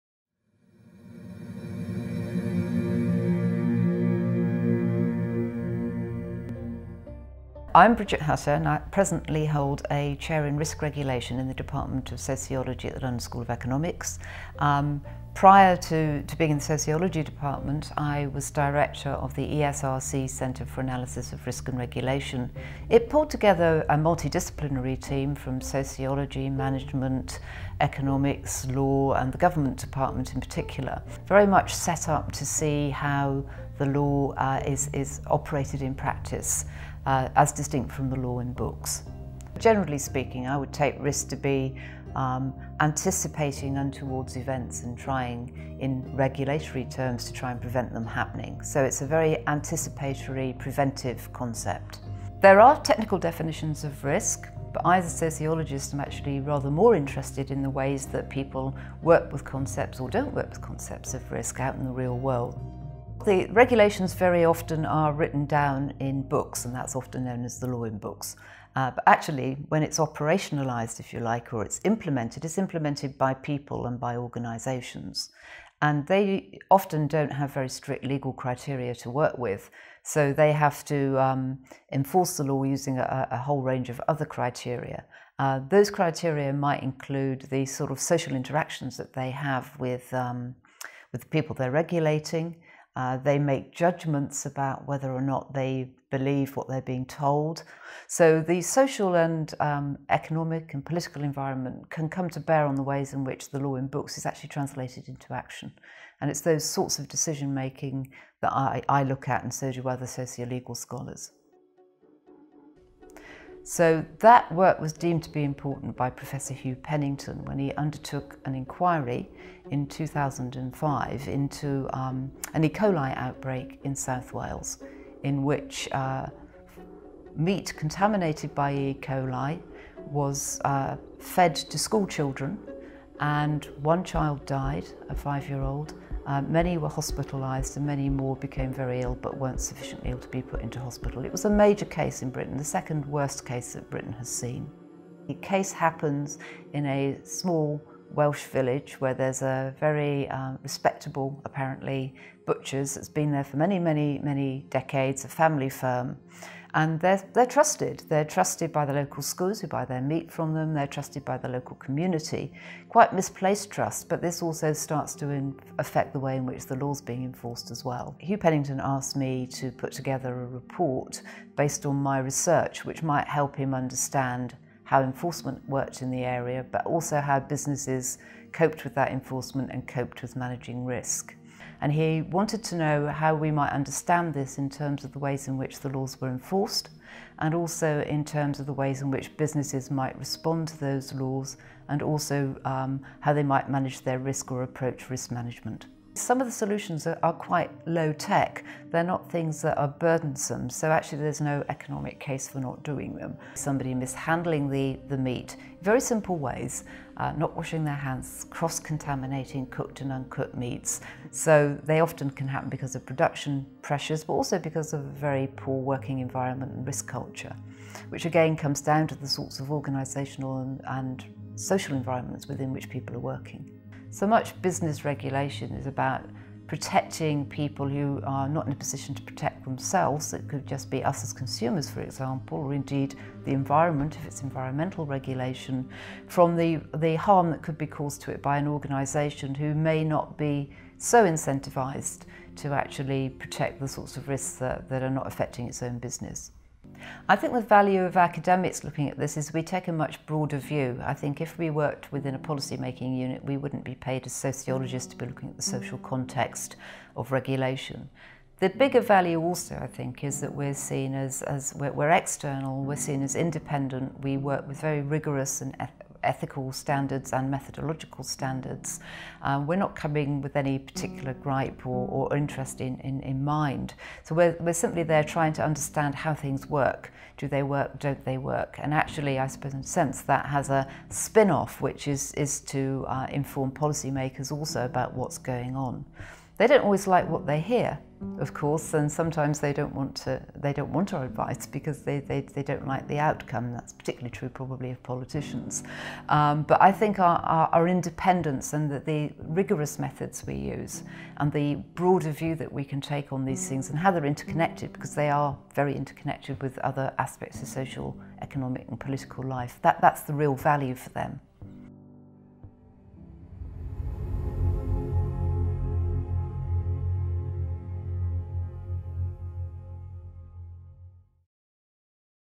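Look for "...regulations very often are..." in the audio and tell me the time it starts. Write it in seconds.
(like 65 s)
63 s.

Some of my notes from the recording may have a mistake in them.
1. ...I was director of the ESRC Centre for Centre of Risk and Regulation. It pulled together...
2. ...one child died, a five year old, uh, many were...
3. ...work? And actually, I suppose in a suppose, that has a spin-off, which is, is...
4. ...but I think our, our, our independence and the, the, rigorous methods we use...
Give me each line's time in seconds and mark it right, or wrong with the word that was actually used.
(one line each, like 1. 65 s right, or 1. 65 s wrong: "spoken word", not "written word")
1. 17 s wrong: "Analysis", not "Centre"
2. 133 s right
3. 278 s wrong: "sense", not "suppose"
4. 296 s right.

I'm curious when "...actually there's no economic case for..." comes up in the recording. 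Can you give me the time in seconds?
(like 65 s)
200 s.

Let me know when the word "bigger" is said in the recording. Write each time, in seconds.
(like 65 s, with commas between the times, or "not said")
258 s.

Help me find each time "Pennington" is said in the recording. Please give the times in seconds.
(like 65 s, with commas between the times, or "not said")
116 s, 168 s.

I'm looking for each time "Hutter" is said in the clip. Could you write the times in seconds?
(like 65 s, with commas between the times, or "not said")
8 s.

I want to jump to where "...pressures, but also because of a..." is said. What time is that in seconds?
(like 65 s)
213 s.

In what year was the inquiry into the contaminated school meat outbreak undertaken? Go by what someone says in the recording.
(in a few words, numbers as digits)
2005.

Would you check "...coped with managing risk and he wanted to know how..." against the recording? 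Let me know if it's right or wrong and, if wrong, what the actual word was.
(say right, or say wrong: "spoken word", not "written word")
right.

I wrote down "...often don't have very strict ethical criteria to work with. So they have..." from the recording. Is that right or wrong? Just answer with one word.
wrong.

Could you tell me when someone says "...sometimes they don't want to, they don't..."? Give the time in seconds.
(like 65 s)
289 s.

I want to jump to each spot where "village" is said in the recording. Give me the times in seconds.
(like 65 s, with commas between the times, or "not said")
148 s.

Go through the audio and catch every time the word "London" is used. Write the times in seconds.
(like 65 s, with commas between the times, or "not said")
12 s.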